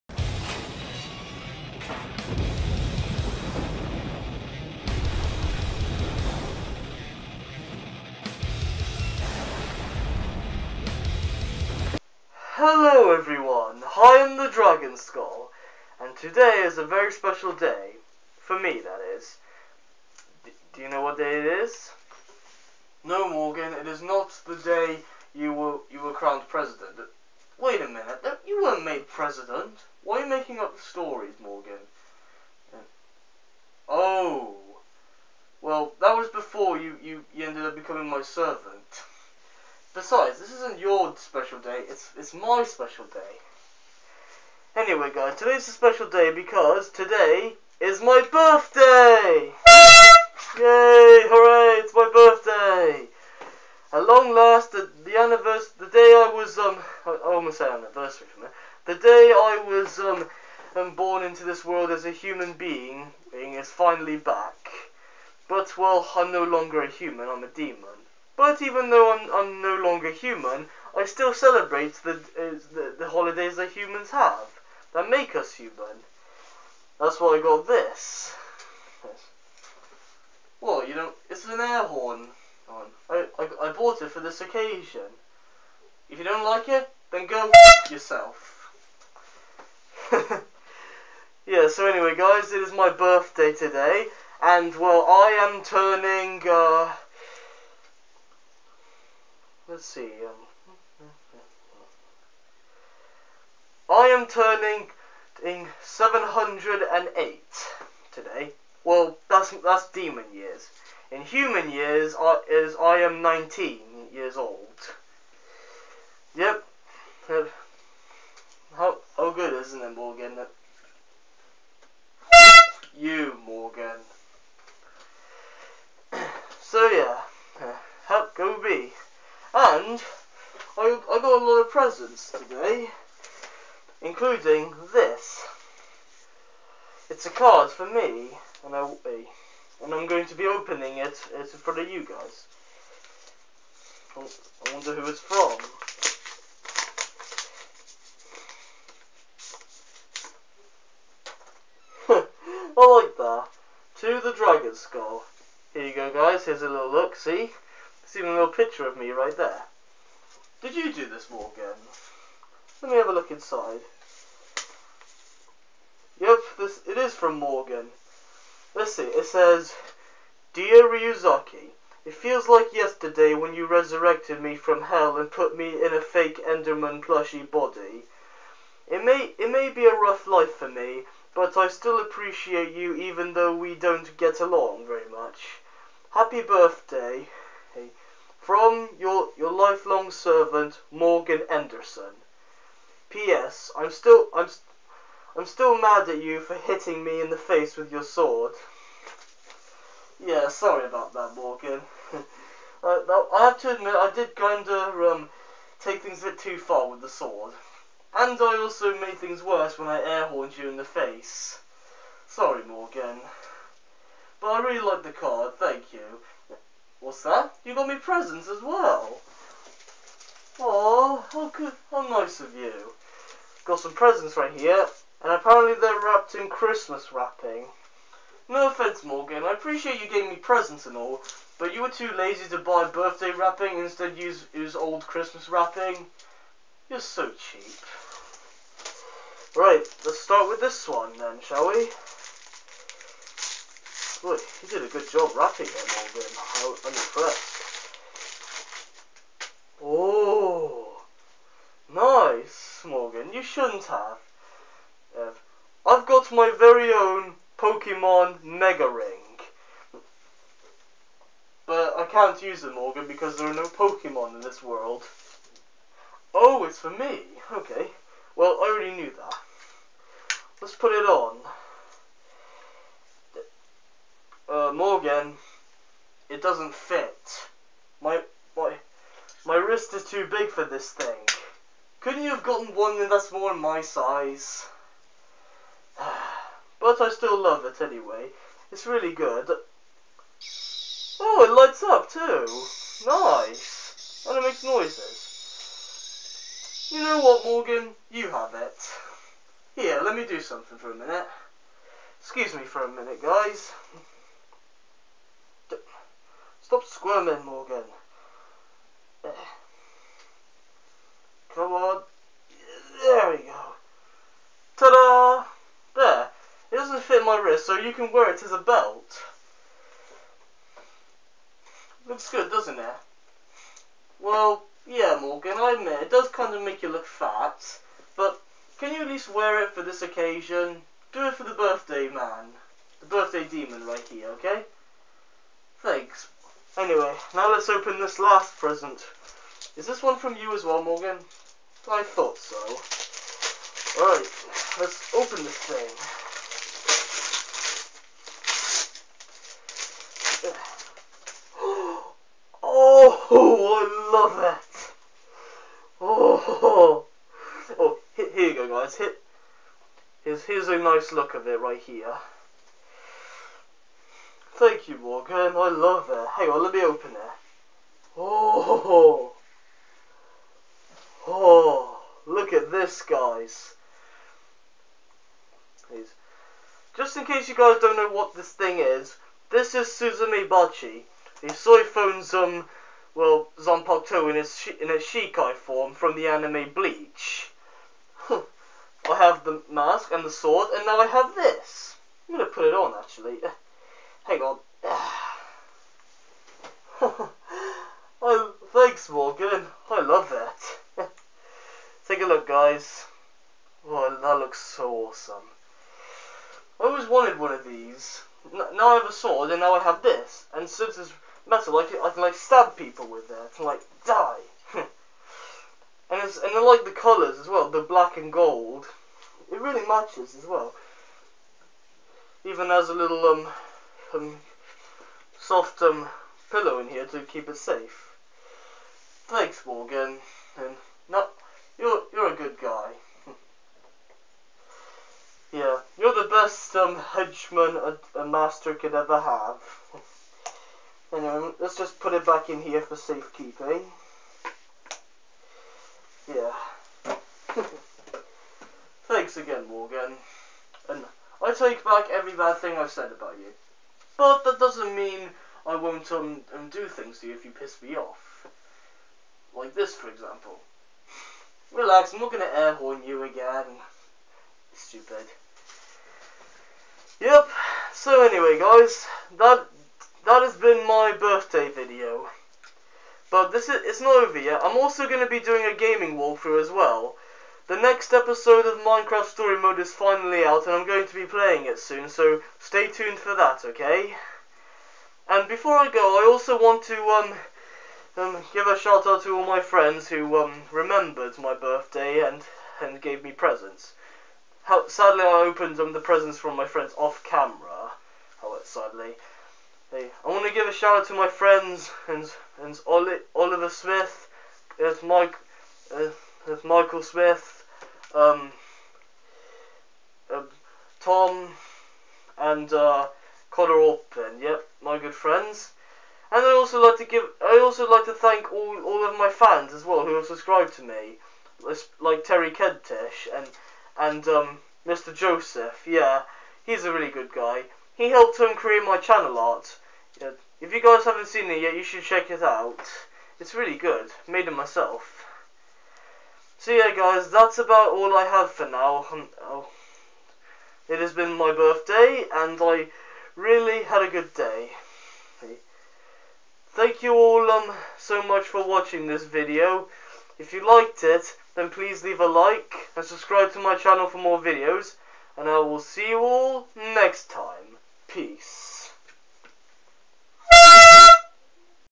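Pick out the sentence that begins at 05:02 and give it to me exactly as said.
Excuse me for a minute, guys.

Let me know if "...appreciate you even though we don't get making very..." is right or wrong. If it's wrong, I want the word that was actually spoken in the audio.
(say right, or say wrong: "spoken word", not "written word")
wrong: "along", not "making".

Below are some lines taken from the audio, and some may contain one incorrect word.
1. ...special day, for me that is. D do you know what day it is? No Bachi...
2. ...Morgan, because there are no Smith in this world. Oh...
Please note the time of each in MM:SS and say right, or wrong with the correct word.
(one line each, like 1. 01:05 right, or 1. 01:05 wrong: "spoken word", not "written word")
1. 00:17 wrong: "Morgan", not "Bachi"
2. 04:22 wrong: "Pokemon", not "Smith".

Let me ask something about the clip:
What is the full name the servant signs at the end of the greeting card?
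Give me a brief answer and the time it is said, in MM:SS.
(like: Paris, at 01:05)
Morgan Anderson, at 03:10.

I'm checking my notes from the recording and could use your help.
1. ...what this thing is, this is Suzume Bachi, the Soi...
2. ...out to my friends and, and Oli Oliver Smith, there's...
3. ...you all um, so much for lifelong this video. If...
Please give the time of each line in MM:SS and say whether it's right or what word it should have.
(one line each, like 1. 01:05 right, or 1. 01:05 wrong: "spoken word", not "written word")
1. 06:18 right
2. 08:21 right
3. 09:07 wrong: "watching", not "lifelong".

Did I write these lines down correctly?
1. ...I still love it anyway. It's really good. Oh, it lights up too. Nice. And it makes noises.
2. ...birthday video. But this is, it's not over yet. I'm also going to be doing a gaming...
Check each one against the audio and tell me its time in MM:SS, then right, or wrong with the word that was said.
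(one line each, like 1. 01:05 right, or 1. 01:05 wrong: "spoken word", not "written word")
1. 04:47 right
2. 07:51 right.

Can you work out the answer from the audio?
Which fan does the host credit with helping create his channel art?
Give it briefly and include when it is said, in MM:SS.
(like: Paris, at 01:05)
Mr. Joseph, at 08:44.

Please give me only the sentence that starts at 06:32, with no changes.
I'm gonna put it on actually.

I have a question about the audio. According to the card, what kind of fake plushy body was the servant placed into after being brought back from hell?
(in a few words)
Enderman.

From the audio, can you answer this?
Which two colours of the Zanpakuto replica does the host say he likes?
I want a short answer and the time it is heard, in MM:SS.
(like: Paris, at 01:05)
Black and gold, at 06:57.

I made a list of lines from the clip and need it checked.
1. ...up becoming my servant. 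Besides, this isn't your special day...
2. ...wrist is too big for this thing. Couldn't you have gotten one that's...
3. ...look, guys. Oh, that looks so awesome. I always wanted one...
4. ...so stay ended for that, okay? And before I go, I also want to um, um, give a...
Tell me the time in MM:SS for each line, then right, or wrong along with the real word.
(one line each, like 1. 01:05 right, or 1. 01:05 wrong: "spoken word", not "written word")
1. 00:37 right
2. 04:39 right
3. 06:42 right
4. 08:02 wrong: "tuned", not "ended".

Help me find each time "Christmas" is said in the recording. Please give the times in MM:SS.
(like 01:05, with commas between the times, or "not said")
03:46, 03:55.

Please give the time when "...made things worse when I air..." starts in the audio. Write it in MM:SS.
03:28.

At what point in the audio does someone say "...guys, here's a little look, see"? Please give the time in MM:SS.
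02:36.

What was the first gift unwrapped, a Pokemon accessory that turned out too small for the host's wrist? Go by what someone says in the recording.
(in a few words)
Mega Ring.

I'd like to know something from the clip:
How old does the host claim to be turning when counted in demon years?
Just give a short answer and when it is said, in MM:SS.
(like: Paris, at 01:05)
708, at 01:45.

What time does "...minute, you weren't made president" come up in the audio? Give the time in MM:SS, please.
00:27.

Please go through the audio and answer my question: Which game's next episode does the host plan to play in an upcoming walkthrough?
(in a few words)
Minecraft Story Mode.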